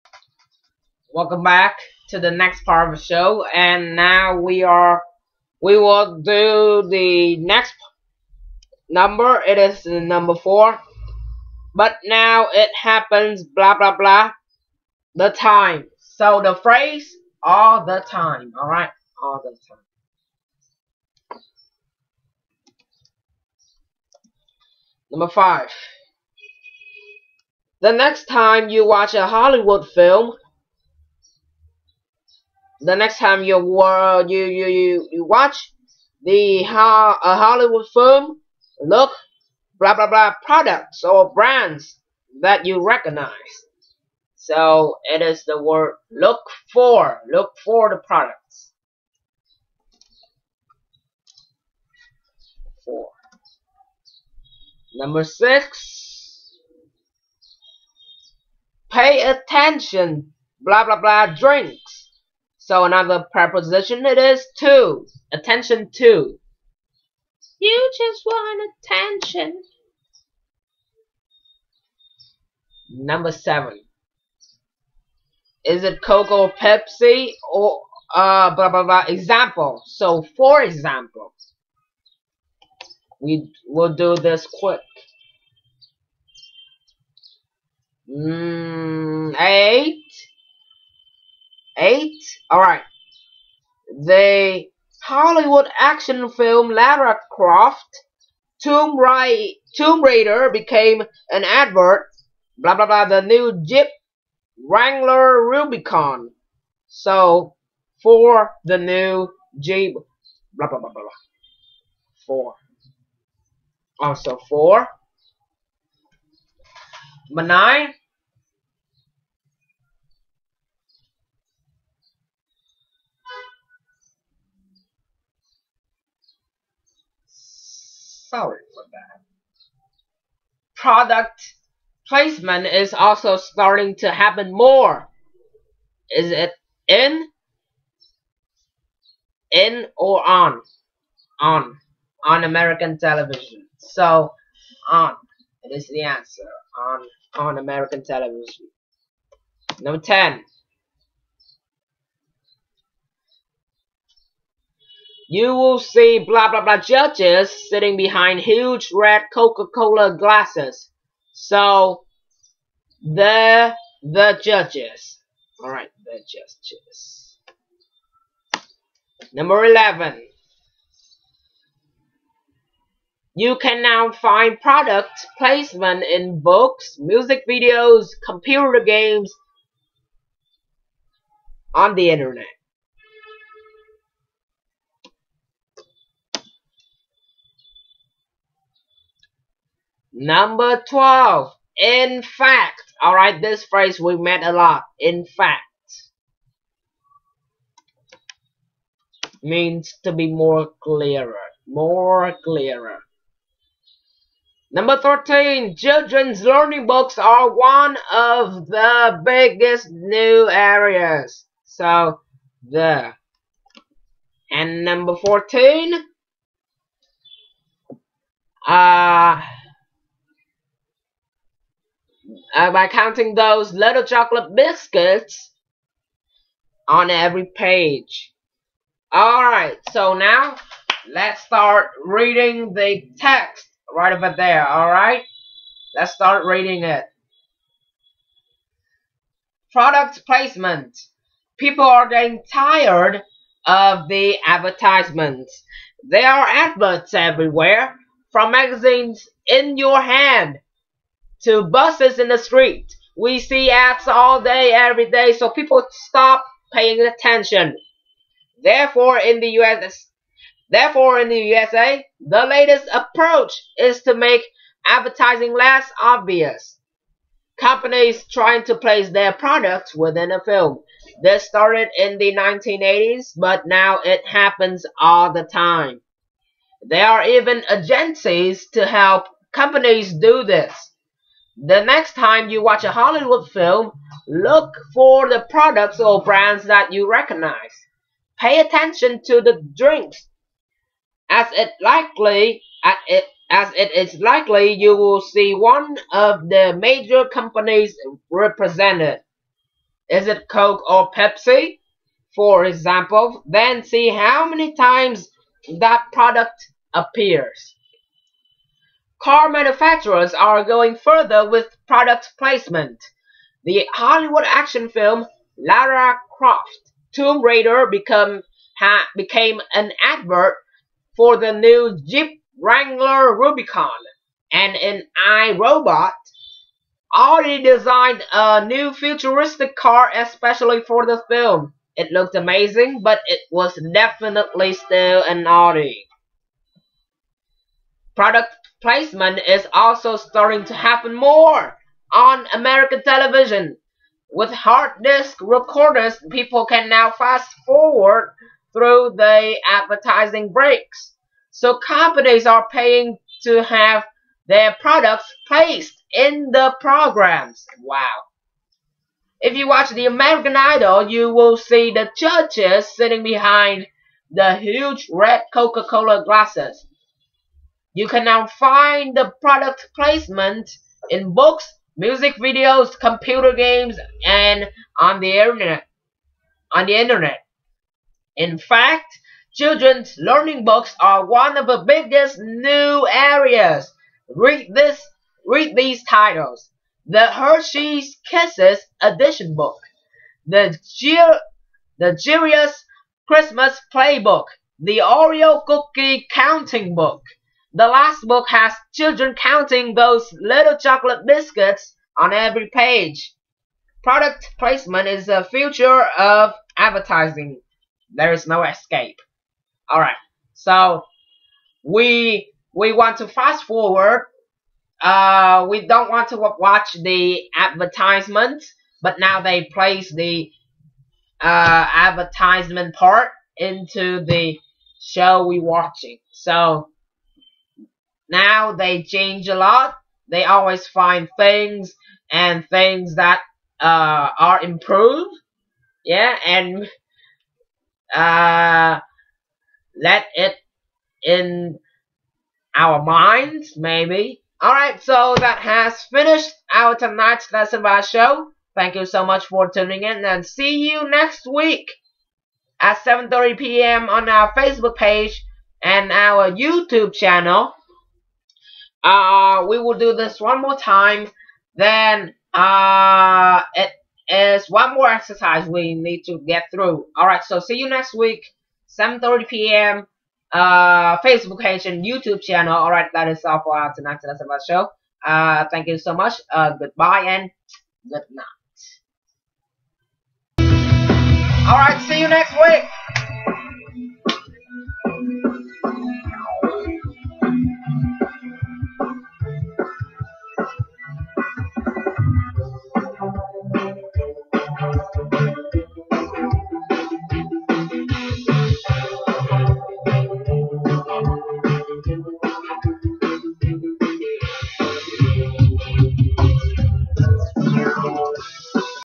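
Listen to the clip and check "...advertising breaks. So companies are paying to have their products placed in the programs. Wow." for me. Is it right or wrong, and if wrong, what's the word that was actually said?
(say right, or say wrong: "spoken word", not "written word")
right.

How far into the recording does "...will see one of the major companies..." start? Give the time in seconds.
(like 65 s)
294 s.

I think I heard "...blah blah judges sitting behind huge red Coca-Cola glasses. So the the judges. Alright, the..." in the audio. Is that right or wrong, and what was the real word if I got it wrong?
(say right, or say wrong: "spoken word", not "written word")
right.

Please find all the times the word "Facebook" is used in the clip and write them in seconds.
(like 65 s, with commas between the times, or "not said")
454 s, 471 s.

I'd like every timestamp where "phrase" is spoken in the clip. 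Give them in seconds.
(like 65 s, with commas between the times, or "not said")
16 s, 193 s.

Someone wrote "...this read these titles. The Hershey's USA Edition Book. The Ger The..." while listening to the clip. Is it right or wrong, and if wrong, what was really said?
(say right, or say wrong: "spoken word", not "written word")
wrong: "Kisses", not "USA".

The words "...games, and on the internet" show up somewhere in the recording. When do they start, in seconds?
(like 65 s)
373 s.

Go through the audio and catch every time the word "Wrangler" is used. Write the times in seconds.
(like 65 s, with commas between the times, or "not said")
104 s, 322 s.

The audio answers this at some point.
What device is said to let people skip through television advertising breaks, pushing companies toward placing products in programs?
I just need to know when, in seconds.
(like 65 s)
344 s.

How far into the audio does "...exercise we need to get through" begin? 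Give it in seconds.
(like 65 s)
465 s.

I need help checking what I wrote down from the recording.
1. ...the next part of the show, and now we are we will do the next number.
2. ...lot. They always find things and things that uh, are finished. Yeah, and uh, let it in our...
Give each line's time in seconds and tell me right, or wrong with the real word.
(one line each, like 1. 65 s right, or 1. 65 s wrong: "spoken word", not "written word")
1. 2 s right
2. 429 s wrong: "improved", not "finished".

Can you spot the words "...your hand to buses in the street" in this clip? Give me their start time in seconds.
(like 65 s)
249 s.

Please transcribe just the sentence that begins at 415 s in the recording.
Uh, we don't want to watch the advertisement, but now they place the uh, advertisement part into the show we're watching.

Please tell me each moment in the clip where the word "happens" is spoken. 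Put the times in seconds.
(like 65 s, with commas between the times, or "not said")
12 s, 134 s, 274 s, 340 s.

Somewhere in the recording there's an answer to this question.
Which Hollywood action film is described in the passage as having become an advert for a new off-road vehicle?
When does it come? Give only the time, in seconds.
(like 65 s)
315 s.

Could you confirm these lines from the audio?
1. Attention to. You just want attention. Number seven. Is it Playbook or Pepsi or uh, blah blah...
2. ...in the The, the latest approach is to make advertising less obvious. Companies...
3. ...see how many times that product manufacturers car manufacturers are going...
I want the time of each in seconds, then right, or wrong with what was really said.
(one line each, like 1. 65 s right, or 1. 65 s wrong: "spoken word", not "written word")
1. 65 s wrong: "Coke", not "Playbook"
2. 261 s wrong: "USA", not "The"
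3. 303 s wrong: "appears", not "manufacturers".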